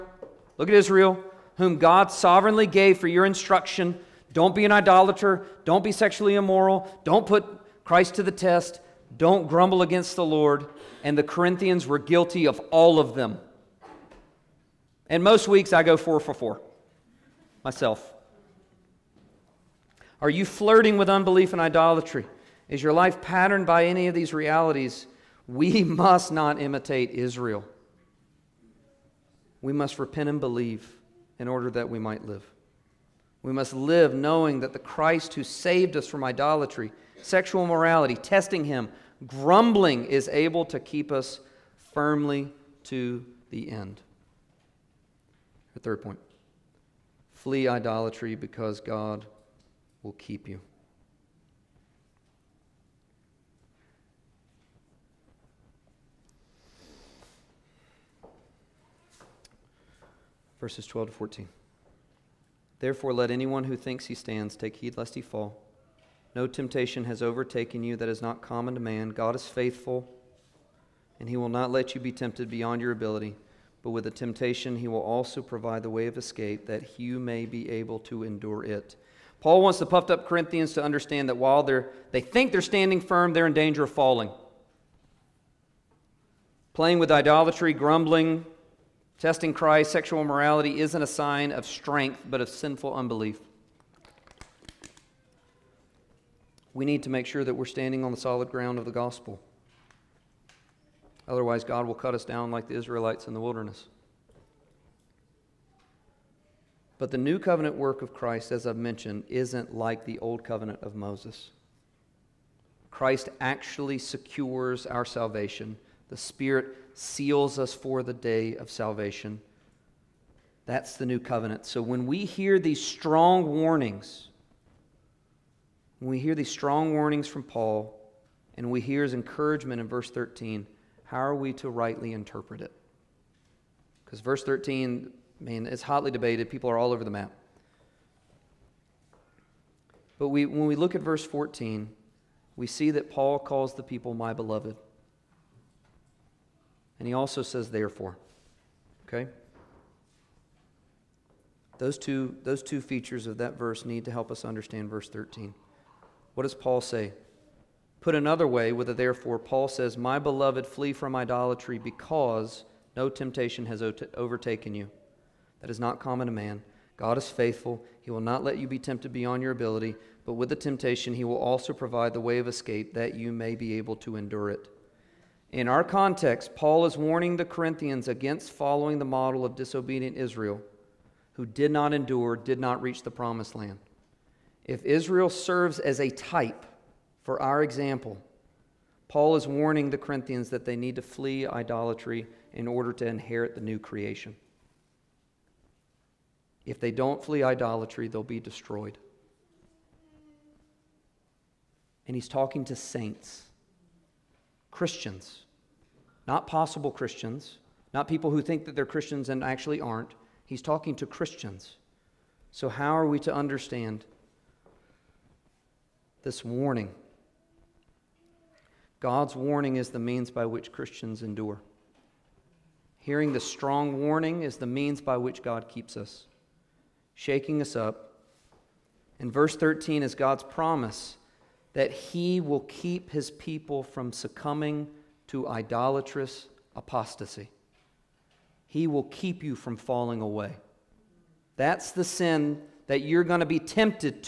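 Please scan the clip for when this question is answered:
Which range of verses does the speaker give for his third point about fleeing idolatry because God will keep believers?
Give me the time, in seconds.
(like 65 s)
60 s.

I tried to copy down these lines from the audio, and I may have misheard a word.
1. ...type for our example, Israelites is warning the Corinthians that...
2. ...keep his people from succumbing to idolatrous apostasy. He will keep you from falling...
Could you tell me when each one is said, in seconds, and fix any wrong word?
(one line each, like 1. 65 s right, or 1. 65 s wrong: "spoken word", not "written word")
1. 186 s wrong: "Paul", not "Israelites"
2. 232 s right.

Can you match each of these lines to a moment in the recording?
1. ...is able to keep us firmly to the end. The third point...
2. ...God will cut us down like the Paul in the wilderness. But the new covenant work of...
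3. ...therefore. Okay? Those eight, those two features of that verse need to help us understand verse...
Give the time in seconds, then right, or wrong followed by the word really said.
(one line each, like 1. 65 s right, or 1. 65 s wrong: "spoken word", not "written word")
1. 40 s right
2. 101 s wrong: "Israelites", not "Paul"
3. 147 s wrong: "two", not "eight".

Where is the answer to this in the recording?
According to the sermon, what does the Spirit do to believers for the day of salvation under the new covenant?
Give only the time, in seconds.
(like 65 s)
116 s.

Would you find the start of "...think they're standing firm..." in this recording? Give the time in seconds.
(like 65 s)
82 s.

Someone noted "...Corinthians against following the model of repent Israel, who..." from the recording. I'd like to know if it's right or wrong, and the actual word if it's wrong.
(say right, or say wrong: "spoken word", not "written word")
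wrong: "disobedient", not "repent".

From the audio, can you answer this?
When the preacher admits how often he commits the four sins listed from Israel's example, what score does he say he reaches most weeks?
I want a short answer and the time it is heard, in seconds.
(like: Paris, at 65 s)
four for four, at 15 s.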